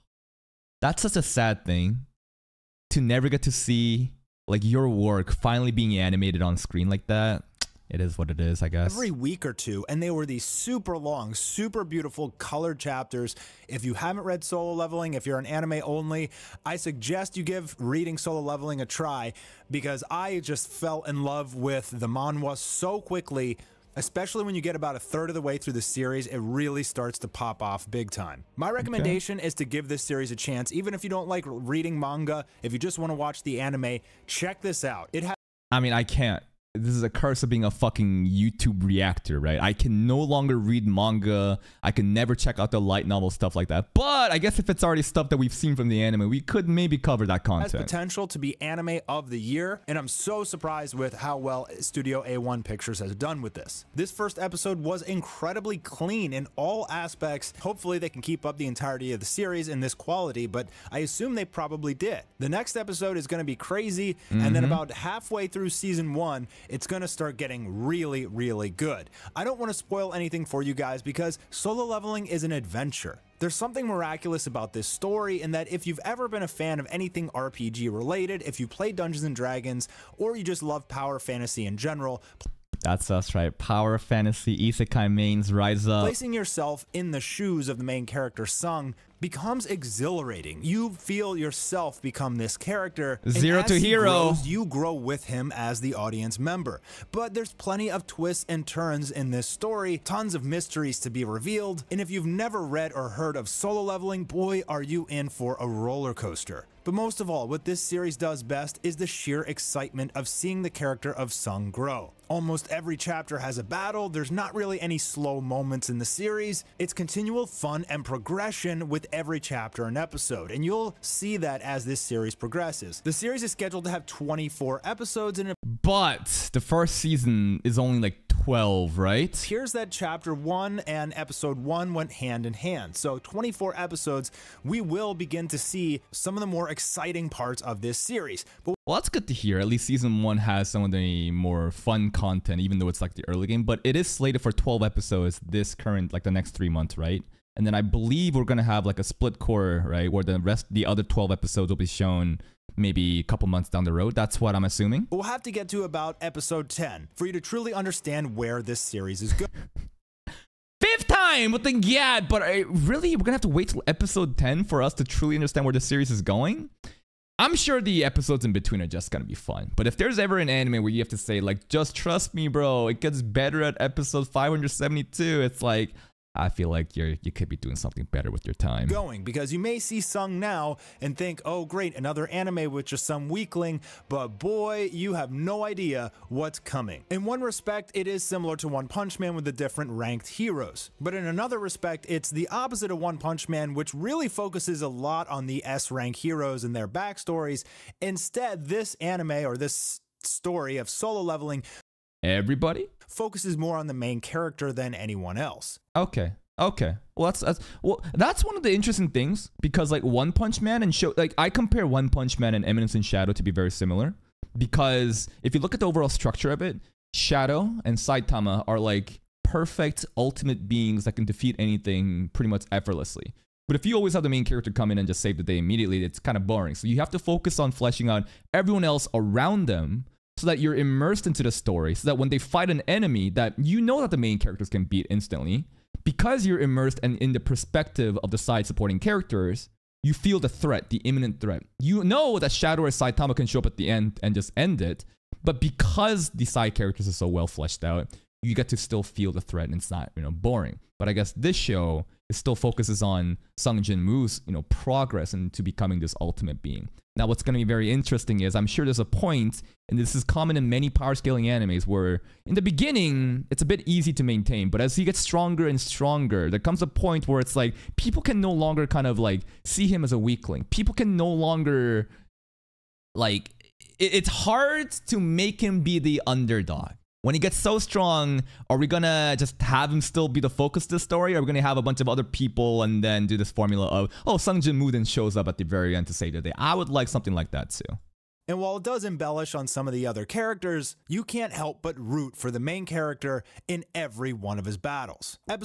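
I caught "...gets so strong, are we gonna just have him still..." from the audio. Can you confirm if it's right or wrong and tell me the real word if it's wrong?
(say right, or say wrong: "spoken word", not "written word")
right.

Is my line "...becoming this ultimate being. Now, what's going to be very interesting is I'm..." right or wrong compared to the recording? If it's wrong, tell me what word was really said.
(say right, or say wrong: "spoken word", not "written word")
right.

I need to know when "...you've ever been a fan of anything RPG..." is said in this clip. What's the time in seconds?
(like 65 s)
75 s.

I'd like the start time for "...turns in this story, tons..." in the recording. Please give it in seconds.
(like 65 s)
98 s.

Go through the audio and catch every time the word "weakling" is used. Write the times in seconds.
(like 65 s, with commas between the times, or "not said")
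183 s, 270 s.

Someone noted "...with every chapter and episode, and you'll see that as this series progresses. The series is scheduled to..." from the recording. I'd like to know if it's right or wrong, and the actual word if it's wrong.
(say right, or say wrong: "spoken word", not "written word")
right.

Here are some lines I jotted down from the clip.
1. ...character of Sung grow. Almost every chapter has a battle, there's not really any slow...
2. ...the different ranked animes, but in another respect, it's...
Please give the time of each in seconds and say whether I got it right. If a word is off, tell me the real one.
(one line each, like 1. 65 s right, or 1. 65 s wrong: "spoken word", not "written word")
1. 110 s right
2. 189 s wrong: "heroes", not "animes".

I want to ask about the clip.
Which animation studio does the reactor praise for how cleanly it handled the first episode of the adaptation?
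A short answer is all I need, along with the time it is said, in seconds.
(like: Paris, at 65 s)
A1 Pictures, at 51 s.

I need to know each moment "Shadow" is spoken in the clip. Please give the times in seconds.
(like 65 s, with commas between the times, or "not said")
213 s, 217 s, 242 s.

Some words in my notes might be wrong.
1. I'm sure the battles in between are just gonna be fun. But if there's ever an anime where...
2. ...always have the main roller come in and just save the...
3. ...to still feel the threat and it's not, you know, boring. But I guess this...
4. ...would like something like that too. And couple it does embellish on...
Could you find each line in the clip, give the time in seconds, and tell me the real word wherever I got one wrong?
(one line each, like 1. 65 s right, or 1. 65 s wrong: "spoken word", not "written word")
1. 167 s wrong: "episodes", not "battles"
2. 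223 s wrong: "character", not "roller"
3. 248 s right
4. 286 s wrong: "while", not "couple".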